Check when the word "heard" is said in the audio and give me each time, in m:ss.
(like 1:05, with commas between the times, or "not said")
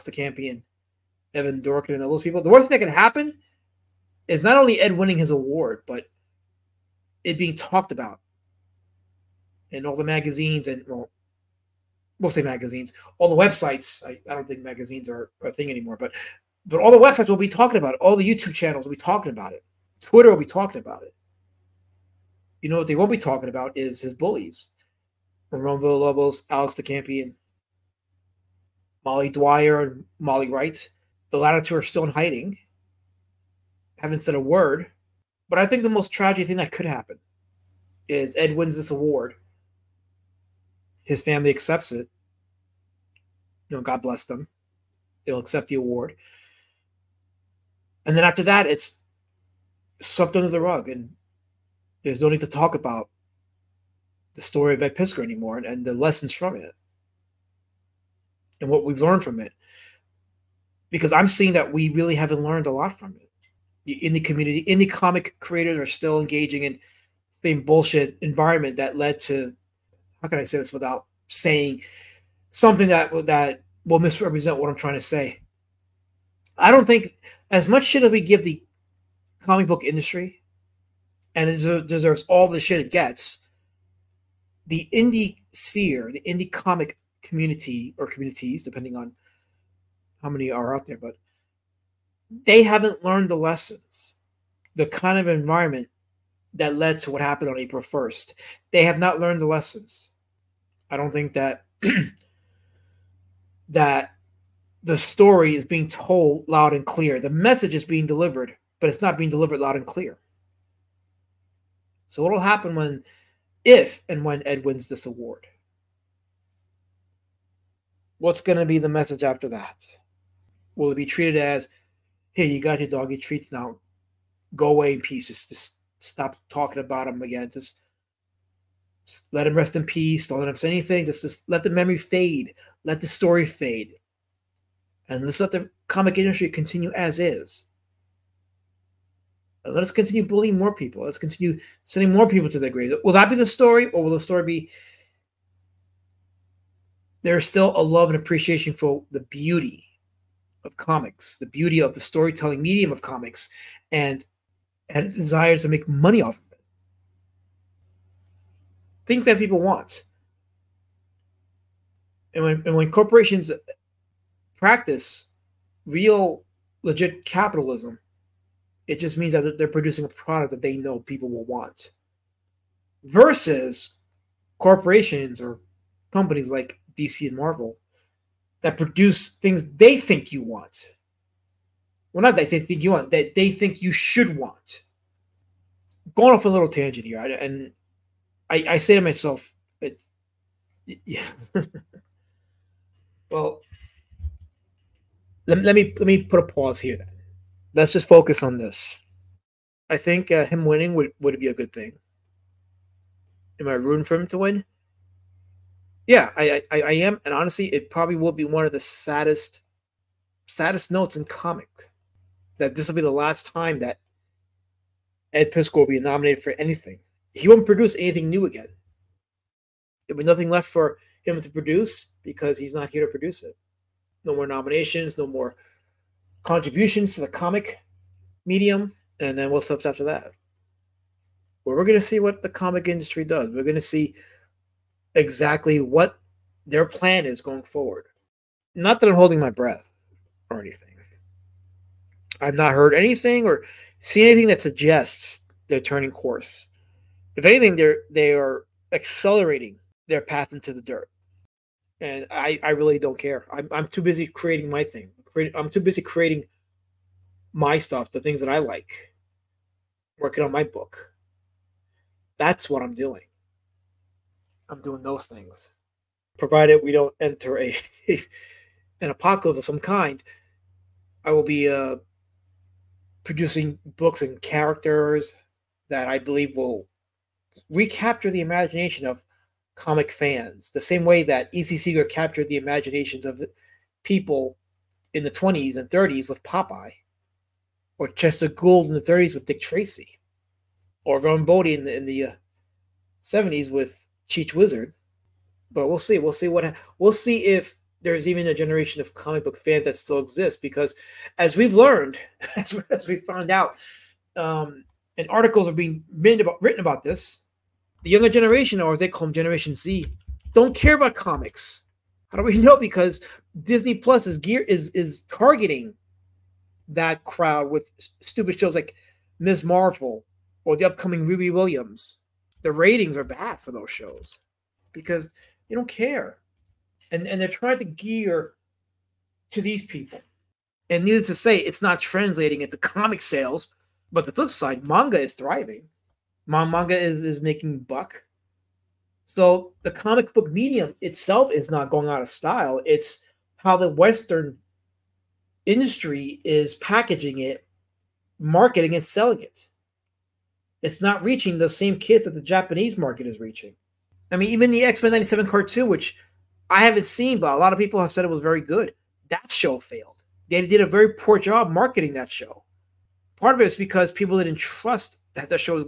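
4:02.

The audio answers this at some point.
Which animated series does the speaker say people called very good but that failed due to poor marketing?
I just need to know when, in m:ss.
5:54.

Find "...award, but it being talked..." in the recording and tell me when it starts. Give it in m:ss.
0:05.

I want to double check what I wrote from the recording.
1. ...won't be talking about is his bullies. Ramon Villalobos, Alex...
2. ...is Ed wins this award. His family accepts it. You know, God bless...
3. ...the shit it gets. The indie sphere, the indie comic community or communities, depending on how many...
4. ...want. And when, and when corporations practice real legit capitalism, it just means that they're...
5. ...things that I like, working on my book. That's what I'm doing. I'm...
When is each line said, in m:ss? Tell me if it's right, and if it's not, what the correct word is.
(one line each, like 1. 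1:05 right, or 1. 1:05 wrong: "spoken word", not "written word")
1. 0:22 right
2. 0:38 right
3. 1:22 right
4. 2:39 right
5. 4:18 right.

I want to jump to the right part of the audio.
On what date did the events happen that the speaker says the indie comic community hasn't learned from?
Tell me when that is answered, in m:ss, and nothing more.
1:37.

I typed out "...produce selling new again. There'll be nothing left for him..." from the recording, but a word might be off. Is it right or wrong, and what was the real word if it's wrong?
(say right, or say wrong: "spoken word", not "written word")
wrong: "anything", not "selling".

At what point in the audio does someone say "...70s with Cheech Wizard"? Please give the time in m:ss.
4:53.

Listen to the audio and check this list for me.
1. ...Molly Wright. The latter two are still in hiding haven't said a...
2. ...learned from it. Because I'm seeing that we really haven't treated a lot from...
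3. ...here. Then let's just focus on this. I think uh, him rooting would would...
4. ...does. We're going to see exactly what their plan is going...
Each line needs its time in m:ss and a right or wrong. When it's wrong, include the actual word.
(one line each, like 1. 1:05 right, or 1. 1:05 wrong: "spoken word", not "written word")
1. 0:30 right
2. 0:59 wrong: "learned", not "treated"
3. 3:16 wrong: "winning", not "rooting"
4. 3:53 right.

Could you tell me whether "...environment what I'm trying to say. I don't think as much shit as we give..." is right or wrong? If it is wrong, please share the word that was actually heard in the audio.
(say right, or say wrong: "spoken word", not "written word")
wrong: "misrepresent", not "environment".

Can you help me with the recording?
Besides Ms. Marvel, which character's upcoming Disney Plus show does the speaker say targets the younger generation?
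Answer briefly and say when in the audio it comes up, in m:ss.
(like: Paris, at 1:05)
Riri Williams, at 5:21.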